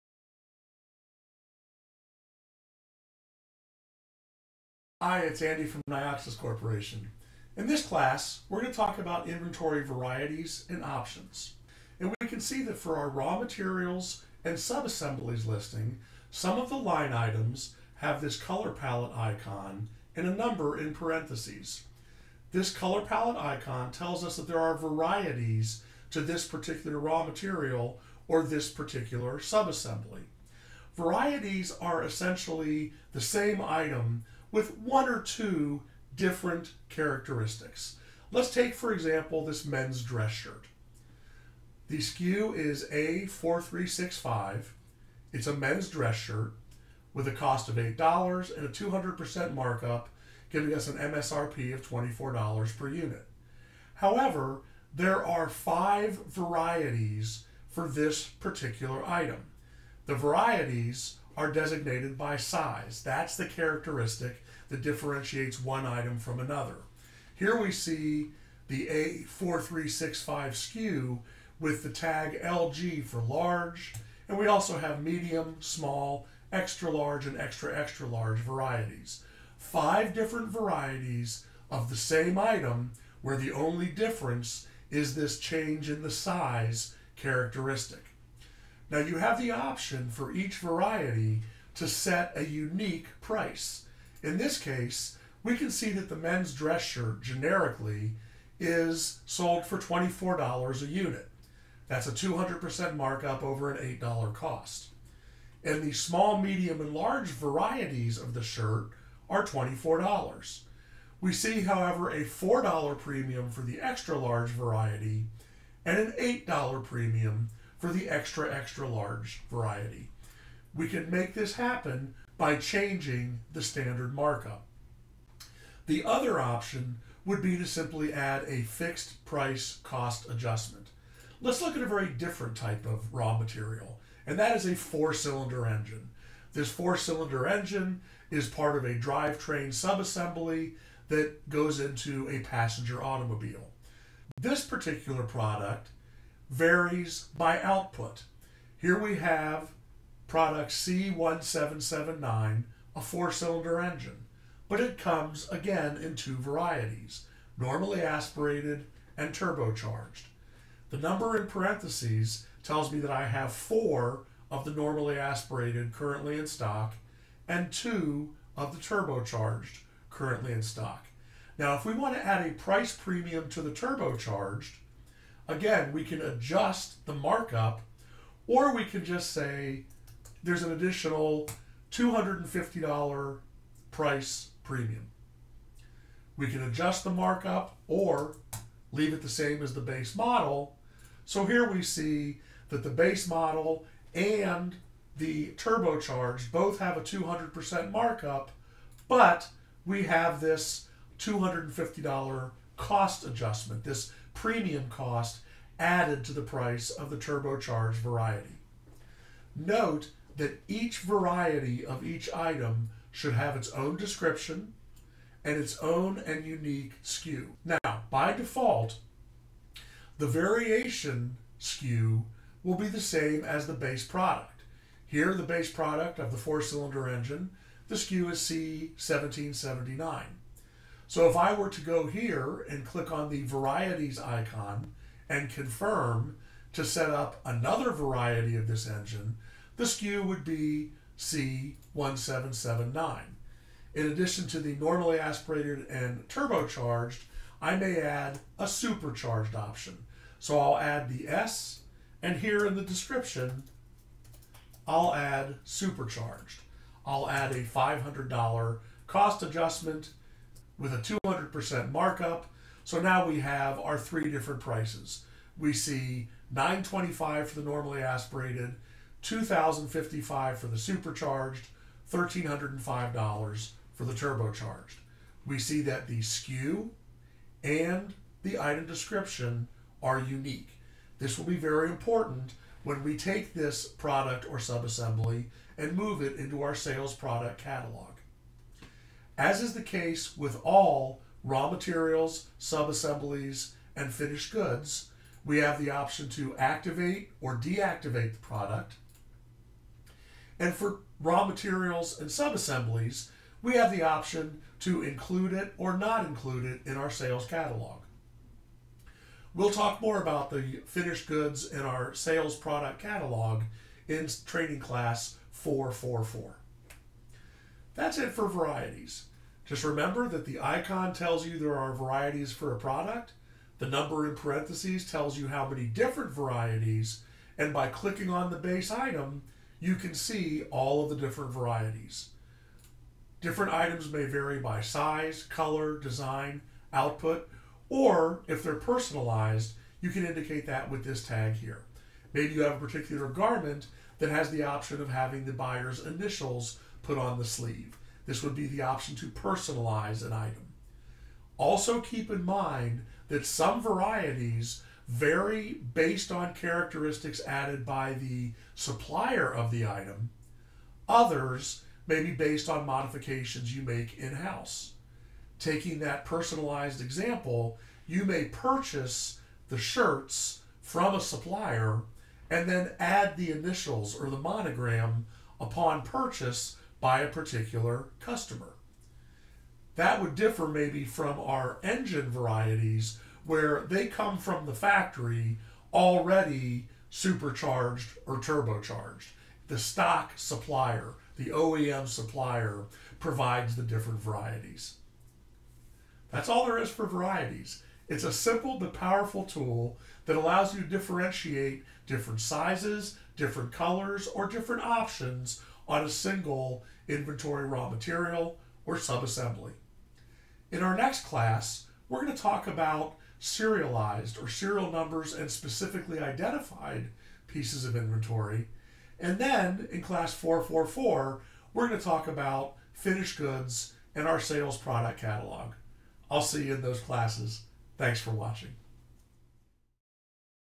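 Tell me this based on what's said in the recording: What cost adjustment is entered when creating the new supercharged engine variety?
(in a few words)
$500.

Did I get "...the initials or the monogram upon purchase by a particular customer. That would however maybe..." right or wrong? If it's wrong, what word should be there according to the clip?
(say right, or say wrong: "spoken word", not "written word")
wrong: "differ", not "however".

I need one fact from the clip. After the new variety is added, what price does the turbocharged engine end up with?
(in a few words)
$1,305.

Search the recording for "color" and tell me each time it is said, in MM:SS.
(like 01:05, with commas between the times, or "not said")
00:18, 00:22, 05:35, 06:43.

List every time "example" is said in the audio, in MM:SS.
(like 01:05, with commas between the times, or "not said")
00:38, 06:07.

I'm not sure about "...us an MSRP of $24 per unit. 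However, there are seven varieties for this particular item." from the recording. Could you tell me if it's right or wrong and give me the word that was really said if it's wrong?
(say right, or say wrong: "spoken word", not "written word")
wrong: "five", not "seven".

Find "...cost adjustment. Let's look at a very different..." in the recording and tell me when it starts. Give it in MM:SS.
02:09.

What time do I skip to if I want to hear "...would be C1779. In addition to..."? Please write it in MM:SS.
04:00.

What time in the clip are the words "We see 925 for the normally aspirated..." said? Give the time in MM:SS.
04:25.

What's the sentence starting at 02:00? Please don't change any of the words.
We can make this happen by changing the standard markup.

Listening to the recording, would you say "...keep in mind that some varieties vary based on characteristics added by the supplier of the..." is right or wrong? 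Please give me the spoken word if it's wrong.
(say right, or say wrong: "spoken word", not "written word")
right.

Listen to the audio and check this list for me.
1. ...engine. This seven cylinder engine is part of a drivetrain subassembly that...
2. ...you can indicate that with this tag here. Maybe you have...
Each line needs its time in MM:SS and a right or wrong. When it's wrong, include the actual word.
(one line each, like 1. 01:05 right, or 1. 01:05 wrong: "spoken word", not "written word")
1. 02:15 wrong: "four", not "seven"
2. 05:40 right.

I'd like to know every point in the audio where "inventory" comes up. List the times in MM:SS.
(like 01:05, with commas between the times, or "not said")
00:09, 06:47, 06:57.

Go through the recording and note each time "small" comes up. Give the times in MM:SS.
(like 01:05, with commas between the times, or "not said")
01:15, 01:45.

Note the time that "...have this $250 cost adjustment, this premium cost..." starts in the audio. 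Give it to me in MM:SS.
03:20.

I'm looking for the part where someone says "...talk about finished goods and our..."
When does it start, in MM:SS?
07:02.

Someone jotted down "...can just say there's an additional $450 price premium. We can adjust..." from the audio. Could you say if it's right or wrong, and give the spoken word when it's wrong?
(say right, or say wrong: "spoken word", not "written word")
wrong: "250", not "450".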